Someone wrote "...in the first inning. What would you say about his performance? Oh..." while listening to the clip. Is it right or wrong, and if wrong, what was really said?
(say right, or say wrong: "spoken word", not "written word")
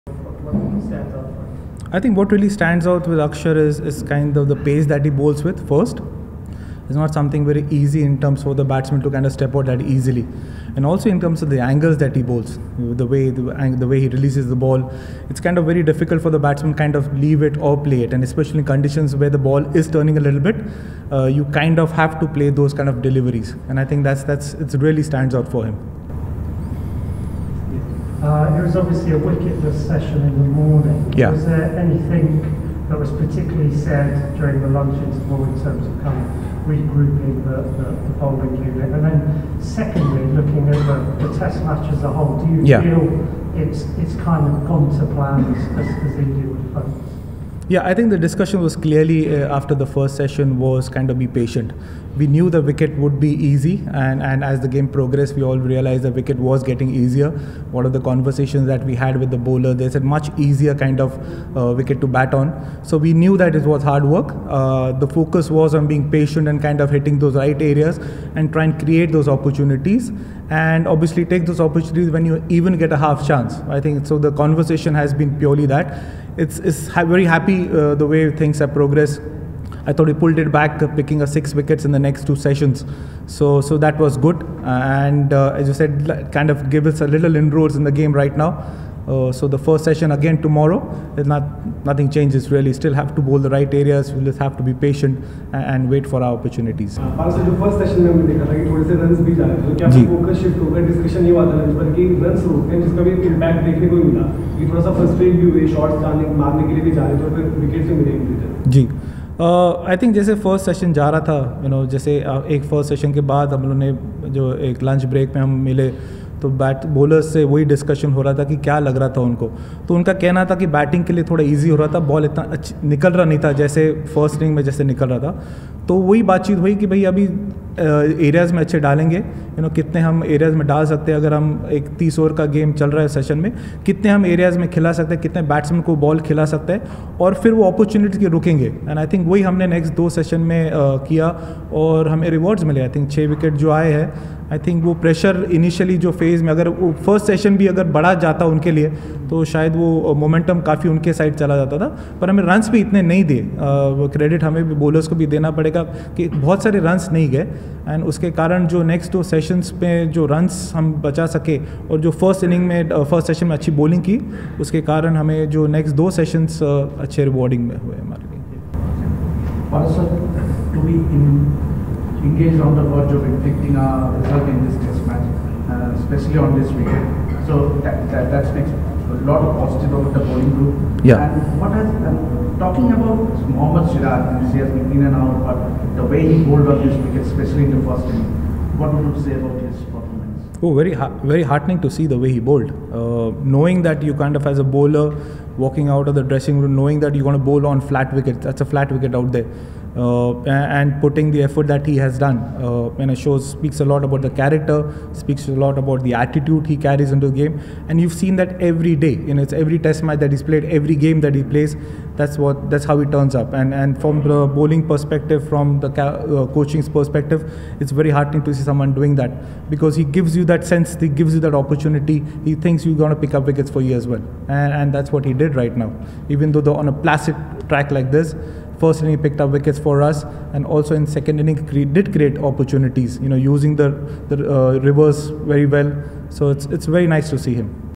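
right.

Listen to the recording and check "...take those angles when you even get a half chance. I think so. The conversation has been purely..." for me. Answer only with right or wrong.
wrong.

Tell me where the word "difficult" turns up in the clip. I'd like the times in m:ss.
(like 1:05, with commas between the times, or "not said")
0:15.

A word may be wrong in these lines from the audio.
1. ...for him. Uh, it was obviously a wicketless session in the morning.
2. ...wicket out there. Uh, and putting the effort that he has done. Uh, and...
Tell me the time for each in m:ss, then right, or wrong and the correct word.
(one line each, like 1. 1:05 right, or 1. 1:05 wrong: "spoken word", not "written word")
1. 0:25 right
2. 3:18 right.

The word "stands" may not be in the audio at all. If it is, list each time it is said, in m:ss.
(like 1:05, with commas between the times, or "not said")
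0:02, 0:25.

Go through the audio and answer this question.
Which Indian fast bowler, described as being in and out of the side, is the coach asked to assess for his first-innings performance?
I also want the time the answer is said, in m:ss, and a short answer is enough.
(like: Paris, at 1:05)
Mohammad Siraj, at 3:03.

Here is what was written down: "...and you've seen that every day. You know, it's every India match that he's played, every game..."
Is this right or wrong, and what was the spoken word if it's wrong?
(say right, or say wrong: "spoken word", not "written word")
wrong: "Test", not "India".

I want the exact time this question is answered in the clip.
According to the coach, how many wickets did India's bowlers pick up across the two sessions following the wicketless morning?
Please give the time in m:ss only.
1:21.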